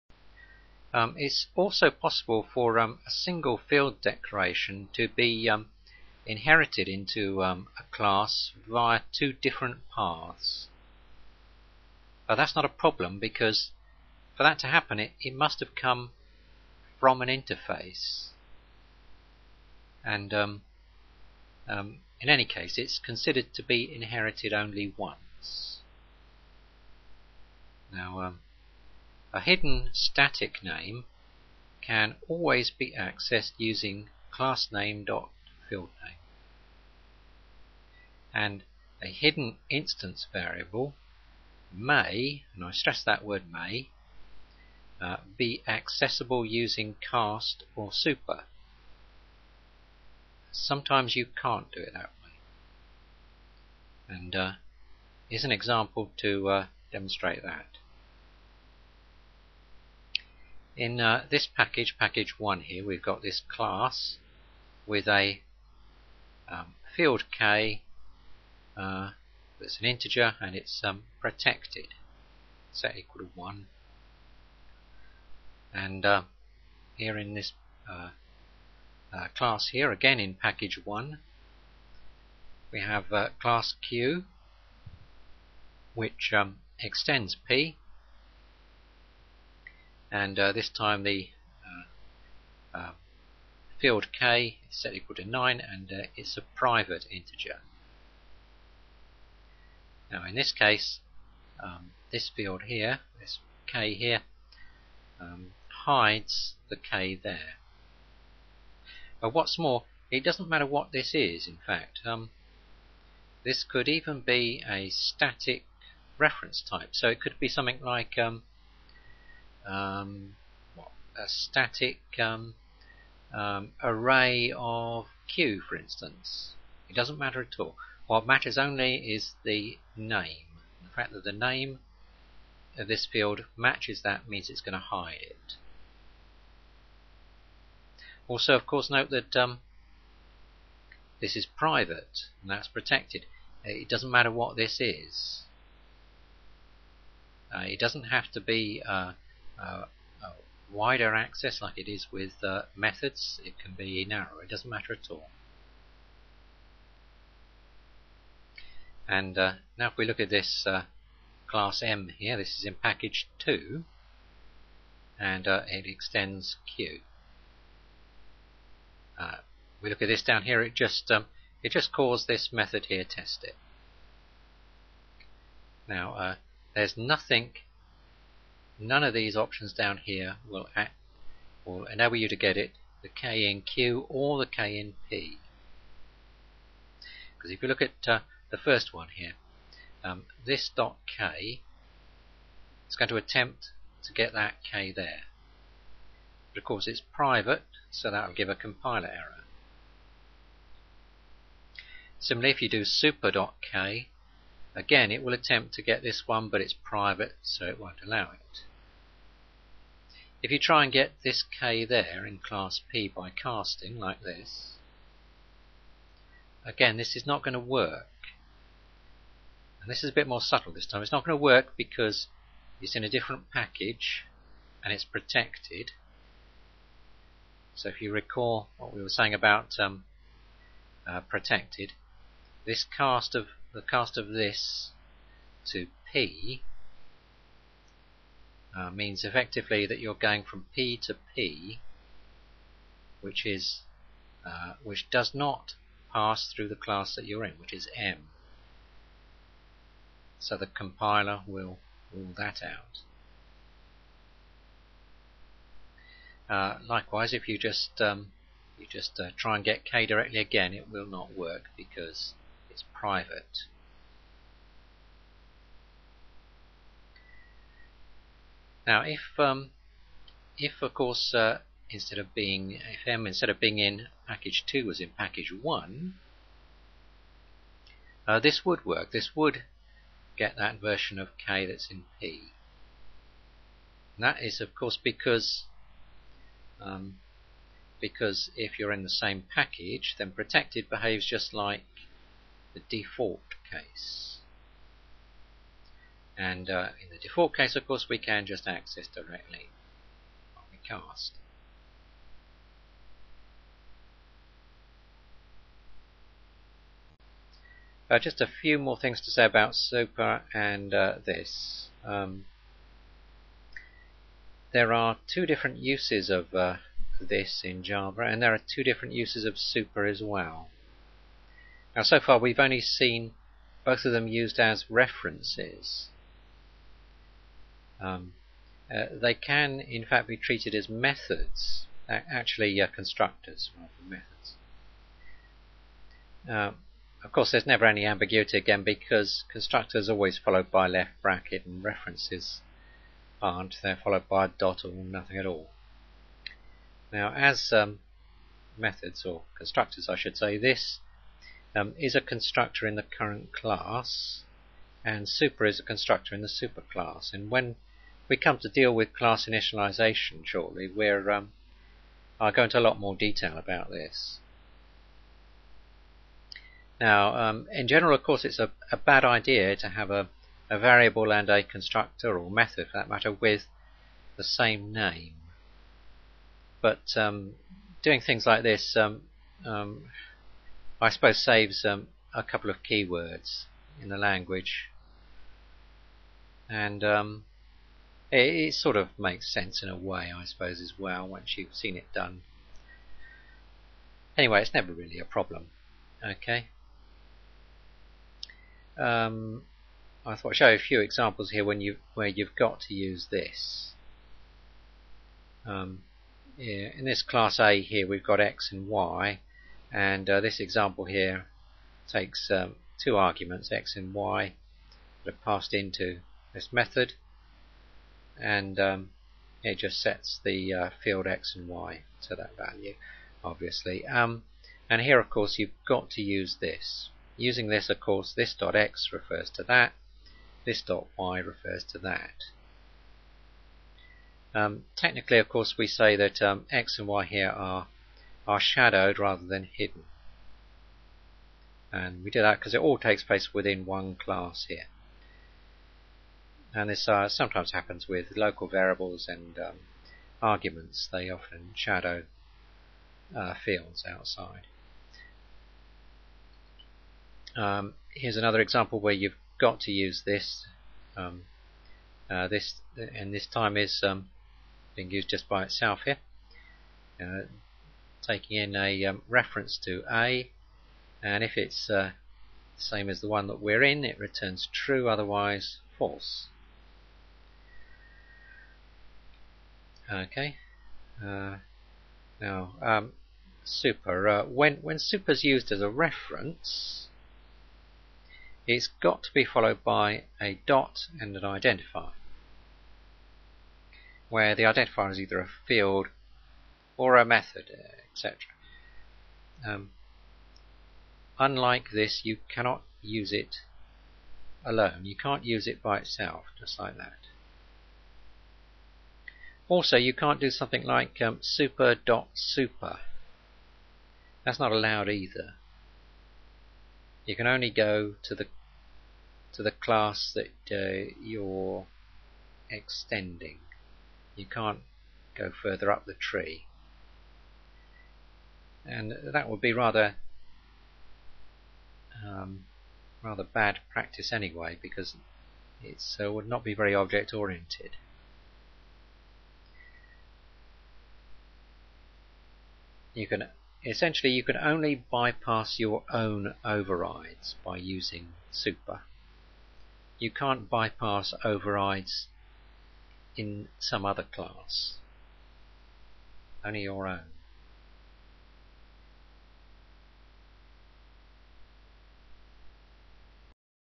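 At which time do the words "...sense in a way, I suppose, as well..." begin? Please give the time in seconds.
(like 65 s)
389 s.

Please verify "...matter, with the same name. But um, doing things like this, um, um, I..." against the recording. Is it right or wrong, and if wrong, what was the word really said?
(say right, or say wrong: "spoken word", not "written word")
right.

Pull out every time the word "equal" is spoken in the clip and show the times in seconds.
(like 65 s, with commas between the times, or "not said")
72 s, 94 s.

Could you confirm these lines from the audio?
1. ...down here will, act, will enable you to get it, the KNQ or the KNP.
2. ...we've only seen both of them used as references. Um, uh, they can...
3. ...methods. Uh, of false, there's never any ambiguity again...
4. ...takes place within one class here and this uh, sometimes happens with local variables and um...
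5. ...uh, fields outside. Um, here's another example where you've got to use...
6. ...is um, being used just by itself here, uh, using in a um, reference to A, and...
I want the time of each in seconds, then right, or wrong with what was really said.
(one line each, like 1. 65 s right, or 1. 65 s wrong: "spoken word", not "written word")
1. 179 s right
2. 322 s right
3. 334 s wrong: "course", not "false"
4. 442 s right
5. 453 s right
6. 463 s wrong: "taking", not "using".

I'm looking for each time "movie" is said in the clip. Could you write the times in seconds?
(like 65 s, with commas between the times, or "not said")
not said.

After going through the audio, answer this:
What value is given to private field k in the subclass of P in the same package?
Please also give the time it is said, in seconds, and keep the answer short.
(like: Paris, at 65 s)
9, at 94 s.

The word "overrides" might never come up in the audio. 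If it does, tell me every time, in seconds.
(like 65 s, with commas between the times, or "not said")
546 s, 551 s.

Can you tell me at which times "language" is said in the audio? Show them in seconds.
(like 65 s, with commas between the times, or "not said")
384 s.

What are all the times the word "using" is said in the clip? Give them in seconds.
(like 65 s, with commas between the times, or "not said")
33 s, 46 s, 427 s, 547 s.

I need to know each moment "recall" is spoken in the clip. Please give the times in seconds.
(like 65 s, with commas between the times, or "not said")
228 s.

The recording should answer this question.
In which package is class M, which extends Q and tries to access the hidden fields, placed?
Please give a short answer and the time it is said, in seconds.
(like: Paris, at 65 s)
package 2, at 162 s.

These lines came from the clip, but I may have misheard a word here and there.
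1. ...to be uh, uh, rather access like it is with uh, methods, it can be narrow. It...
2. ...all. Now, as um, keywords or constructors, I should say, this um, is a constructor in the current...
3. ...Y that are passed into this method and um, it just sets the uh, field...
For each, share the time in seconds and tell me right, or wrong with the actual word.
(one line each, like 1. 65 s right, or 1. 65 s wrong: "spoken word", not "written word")
1. 148 s wrong: "wider", not "rather"
2. 345 s wrong: "methods", not "keywords"
3. 414 s right.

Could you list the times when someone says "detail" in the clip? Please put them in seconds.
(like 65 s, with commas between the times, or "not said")
363 s.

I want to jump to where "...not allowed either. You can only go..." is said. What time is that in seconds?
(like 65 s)
514 s.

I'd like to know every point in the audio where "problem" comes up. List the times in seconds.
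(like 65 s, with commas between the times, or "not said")
12 s, 395 s.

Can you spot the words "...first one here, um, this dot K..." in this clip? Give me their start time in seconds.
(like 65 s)
188 s.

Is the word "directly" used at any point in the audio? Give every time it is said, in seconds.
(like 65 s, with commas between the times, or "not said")
260 s, 299 s.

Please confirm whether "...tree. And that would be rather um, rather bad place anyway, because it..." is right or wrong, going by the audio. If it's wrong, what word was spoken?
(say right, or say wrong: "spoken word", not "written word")
wrong: "practice", not "place".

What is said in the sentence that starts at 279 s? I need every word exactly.
This would get that version of K that's in P.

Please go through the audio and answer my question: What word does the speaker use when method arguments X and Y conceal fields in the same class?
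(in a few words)
shadowed.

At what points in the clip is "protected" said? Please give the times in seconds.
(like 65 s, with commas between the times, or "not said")
71 s, 142 s, 225 s, 231 s, 290 s.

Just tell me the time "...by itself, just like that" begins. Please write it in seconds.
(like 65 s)
505 s.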